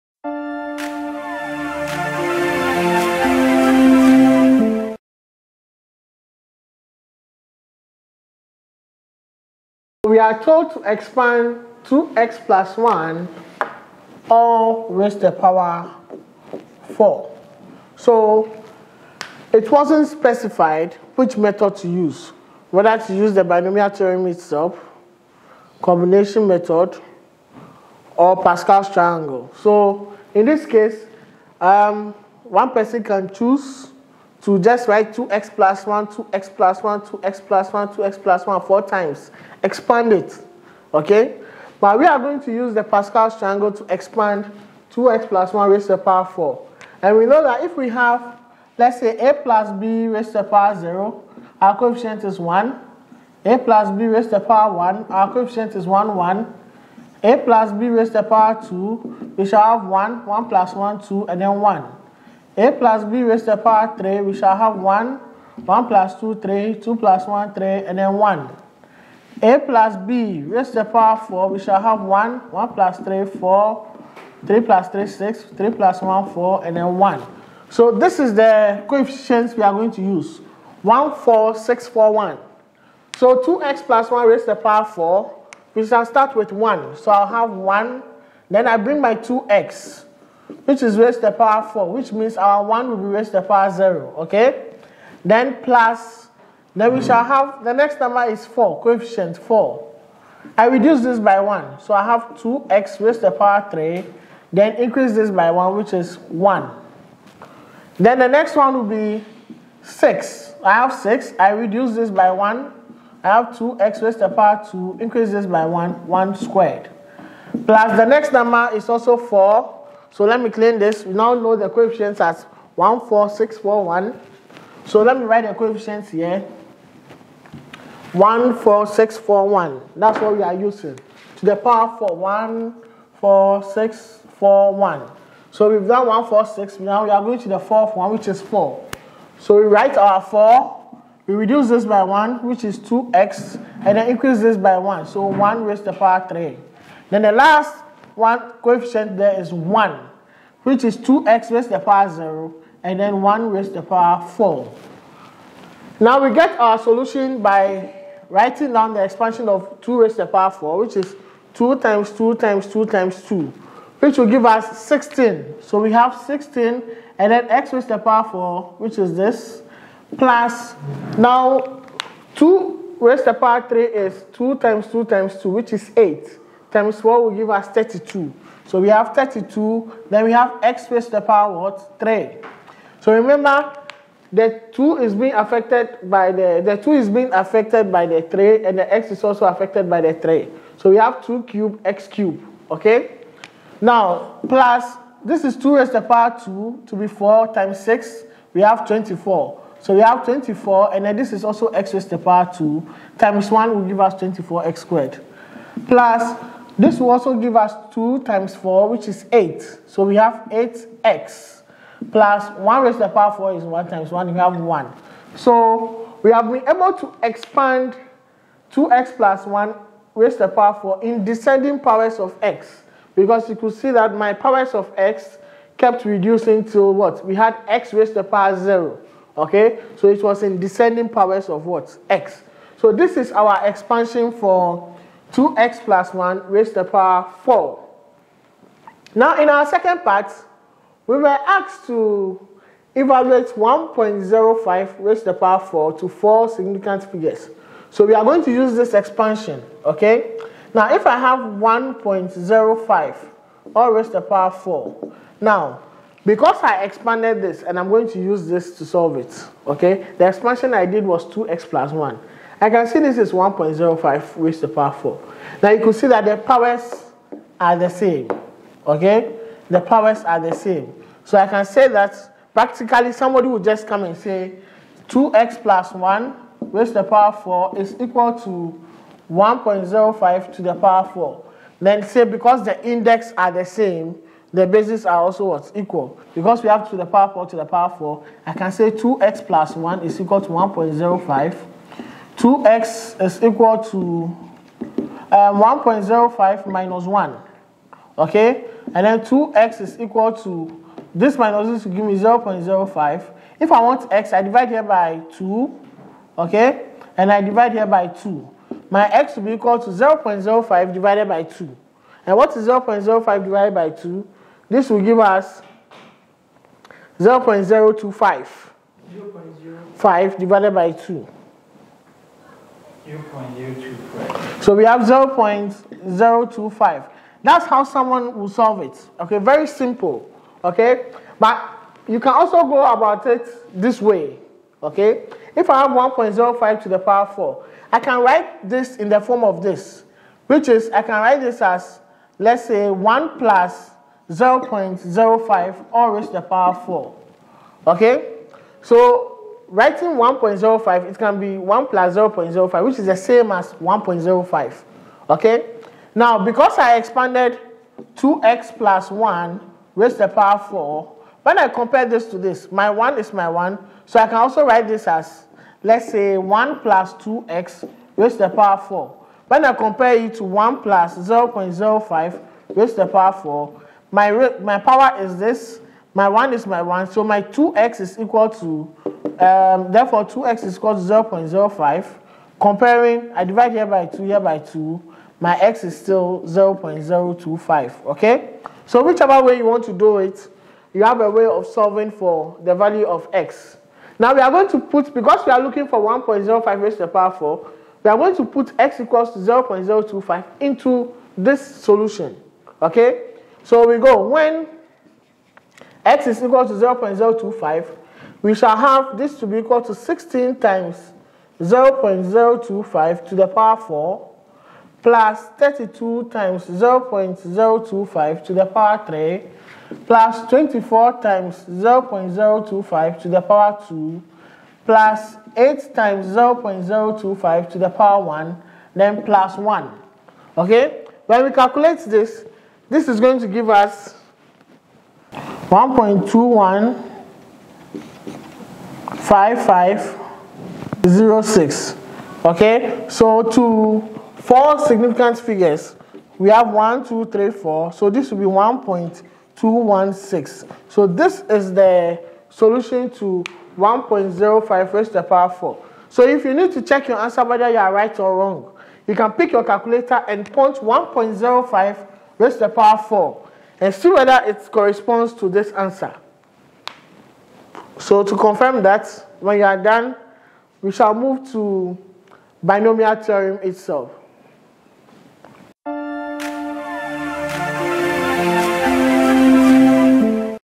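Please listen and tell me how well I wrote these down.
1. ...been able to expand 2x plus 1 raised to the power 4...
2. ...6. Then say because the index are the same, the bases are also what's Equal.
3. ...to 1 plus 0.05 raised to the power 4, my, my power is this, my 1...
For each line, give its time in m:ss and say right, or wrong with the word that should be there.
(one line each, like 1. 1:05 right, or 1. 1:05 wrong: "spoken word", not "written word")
1. 3:36 right
2. 4:41 wrong: "4", not "6"
3. 6:10 right.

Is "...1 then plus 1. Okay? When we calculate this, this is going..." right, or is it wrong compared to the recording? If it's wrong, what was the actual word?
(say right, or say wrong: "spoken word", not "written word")
right.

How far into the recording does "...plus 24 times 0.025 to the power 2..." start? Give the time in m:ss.
7:00.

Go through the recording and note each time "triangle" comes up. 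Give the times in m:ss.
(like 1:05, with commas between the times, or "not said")
0:28, 0:43.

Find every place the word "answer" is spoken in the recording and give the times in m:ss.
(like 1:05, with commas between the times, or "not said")
7:37, 7:45.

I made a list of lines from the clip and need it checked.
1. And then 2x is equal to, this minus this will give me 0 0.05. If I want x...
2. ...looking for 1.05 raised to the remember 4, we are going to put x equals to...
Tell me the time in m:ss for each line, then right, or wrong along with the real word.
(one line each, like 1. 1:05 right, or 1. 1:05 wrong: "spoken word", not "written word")
1. 4:58 right
2. 6:35 wrong: "power", not "remember".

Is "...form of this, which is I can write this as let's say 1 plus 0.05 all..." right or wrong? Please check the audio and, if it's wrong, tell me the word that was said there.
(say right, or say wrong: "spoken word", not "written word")
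right.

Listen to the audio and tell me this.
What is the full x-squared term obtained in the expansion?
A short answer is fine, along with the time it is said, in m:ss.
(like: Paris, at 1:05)
24x squared, at 3:24.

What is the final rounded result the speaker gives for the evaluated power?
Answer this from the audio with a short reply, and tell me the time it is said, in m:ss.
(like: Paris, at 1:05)
1.216, at 7:28.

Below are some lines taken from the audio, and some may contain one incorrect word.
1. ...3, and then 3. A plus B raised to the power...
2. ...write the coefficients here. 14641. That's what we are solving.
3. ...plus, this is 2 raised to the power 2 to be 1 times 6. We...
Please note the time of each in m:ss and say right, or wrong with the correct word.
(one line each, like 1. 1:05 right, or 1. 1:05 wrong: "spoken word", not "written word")
1. 1:07 wrong: "1", not "3"
2. 2:05 wrong: "using", not "solving"
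3. 3:14 wrong: "4", not "1".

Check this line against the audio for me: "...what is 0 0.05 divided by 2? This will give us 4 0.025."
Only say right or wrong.
wrong.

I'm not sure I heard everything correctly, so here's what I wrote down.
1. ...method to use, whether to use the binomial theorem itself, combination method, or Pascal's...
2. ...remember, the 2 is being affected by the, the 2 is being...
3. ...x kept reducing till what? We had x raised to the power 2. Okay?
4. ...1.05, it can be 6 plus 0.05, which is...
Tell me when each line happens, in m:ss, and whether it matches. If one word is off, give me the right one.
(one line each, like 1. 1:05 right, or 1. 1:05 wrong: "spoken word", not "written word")
1. 0:21 right
2. 3:03 right
3. 3:44 wrong: "0", not "2"
4. 5:50 wrong: "1", not "6".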